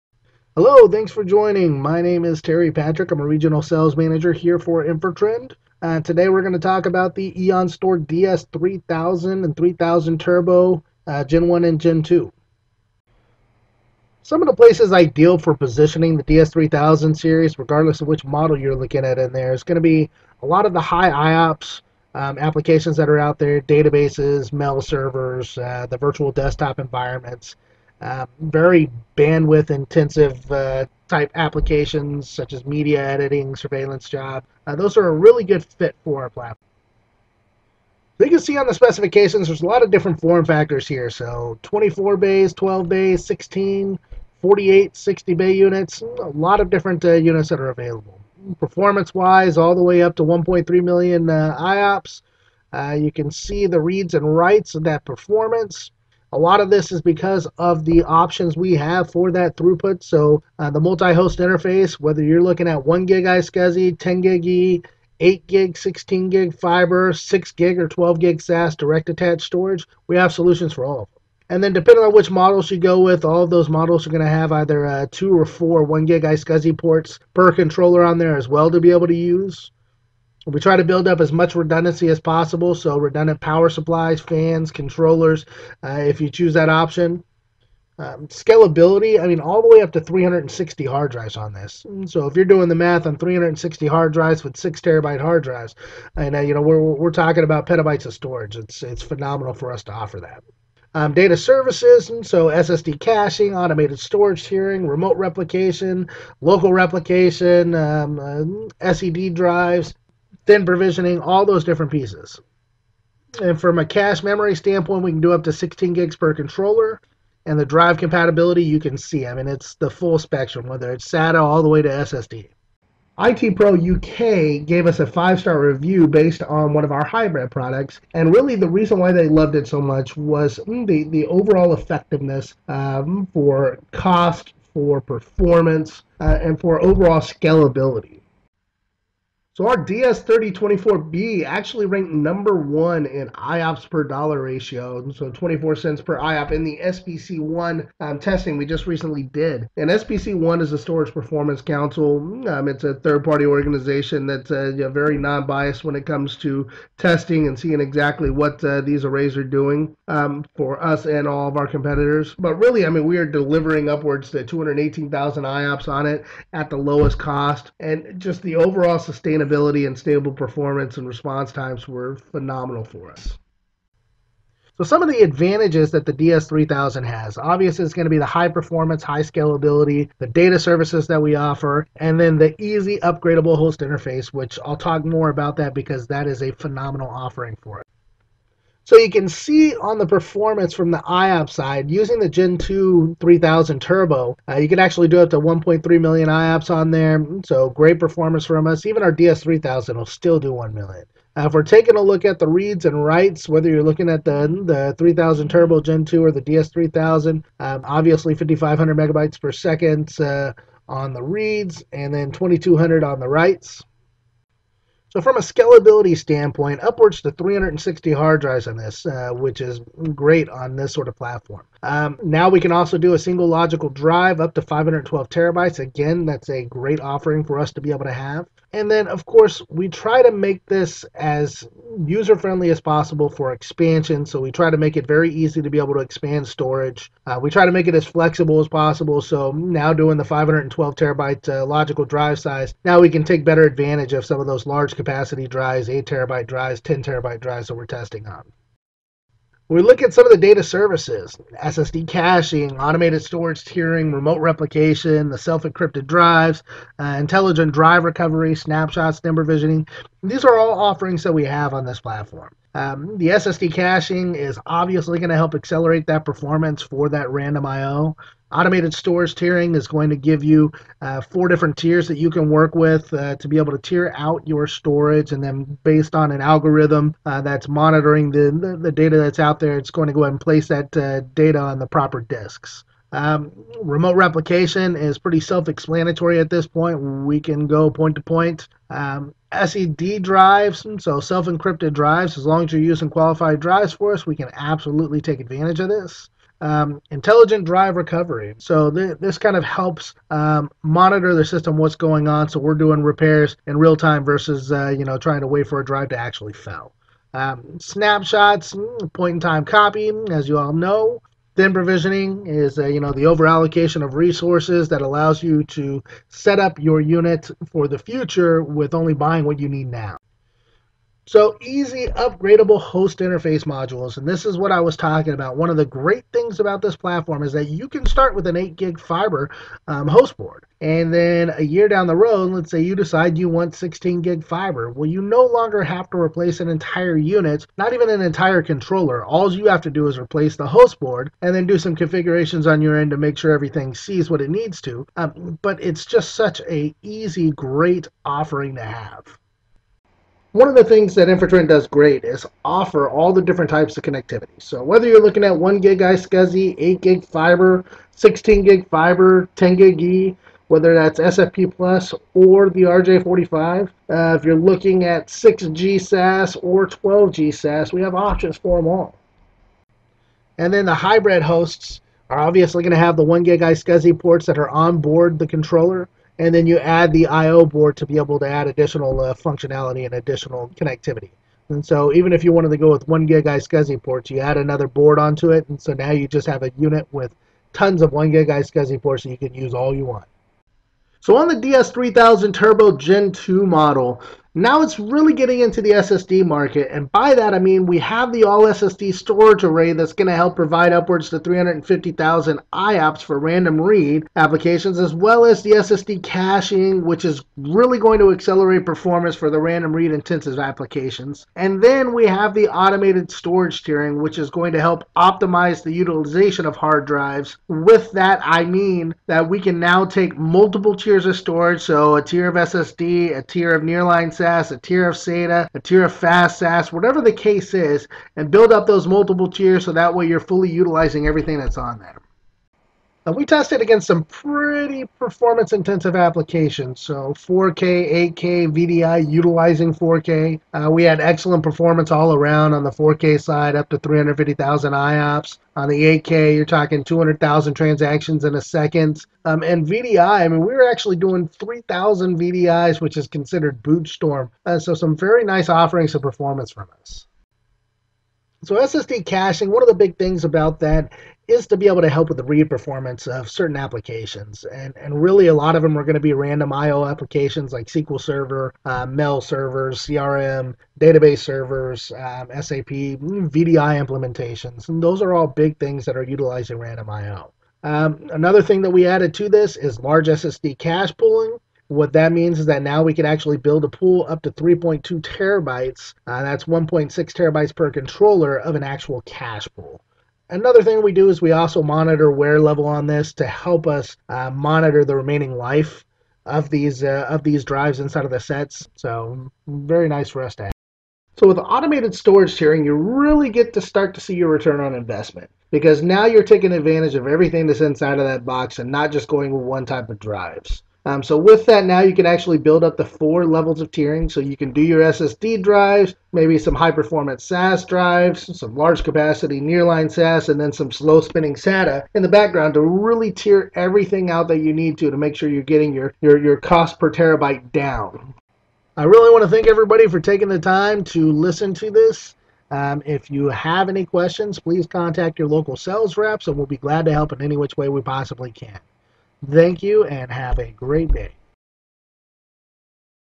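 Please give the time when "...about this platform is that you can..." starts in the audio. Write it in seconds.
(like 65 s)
326 s.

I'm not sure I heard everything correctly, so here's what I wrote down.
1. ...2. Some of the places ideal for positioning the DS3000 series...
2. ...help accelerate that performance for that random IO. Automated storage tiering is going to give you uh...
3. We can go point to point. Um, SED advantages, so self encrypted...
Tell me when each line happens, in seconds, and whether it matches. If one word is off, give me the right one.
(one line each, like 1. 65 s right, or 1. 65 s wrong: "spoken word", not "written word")
1. 12 s right
2. 265 s right
3. 287 s wrong: "drives", not "advantages".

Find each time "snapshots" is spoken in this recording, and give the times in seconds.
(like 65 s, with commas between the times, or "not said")
258 s, 307 s.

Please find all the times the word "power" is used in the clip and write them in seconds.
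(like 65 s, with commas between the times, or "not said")
83 s.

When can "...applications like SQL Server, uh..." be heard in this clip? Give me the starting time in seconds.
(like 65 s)
467 s.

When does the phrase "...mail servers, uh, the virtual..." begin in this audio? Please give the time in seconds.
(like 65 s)
24 s.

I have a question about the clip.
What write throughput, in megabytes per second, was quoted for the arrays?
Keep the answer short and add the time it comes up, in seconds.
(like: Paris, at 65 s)
2200, at 212 s.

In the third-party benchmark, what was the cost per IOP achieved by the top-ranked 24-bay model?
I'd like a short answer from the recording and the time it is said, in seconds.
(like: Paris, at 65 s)
24 cents, at 145 s.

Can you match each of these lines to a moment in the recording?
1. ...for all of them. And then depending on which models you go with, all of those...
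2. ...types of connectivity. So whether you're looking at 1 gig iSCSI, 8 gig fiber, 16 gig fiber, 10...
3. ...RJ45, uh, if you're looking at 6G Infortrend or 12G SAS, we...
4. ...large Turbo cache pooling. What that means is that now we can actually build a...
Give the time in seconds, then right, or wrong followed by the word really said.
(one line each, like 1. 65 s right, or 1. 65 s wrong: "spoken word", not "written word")
1. 70 s right
2. 353 s right
3. 362 s wrong: "SAS", not "Infortrend"
4. 479 s wrong: "SSD", not "Turbo".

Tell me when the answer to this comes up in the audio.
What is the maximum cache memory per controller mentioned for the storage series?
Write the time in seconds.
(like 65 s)
115 s.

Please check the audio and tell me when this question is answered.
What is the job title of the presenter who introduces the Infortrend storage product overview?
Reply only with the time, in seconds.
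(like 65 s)
3 s.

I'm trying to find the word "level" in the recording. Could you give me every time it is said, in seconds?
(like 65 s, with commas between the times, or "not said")
492 s, 513 s.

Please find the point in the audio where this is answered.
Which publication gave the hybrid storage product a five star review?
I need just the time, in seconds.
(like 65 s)
123 s.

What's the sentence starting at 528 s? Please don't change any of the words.
I really want to thank everybody for taking the time to listen to this.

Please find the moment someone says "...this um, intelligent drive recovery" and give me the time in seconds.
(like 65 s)
295 s.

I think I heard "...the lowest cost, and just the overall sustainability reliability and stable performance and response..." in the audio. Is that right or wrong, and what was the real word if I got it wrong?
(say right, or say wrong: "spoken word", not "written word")
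right.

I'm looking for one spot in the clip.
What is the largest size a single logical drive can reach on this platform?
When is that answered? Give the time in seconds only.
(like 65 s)
224 s.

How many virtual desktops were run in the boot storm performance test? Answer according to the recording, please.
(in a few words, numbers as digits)
3,000.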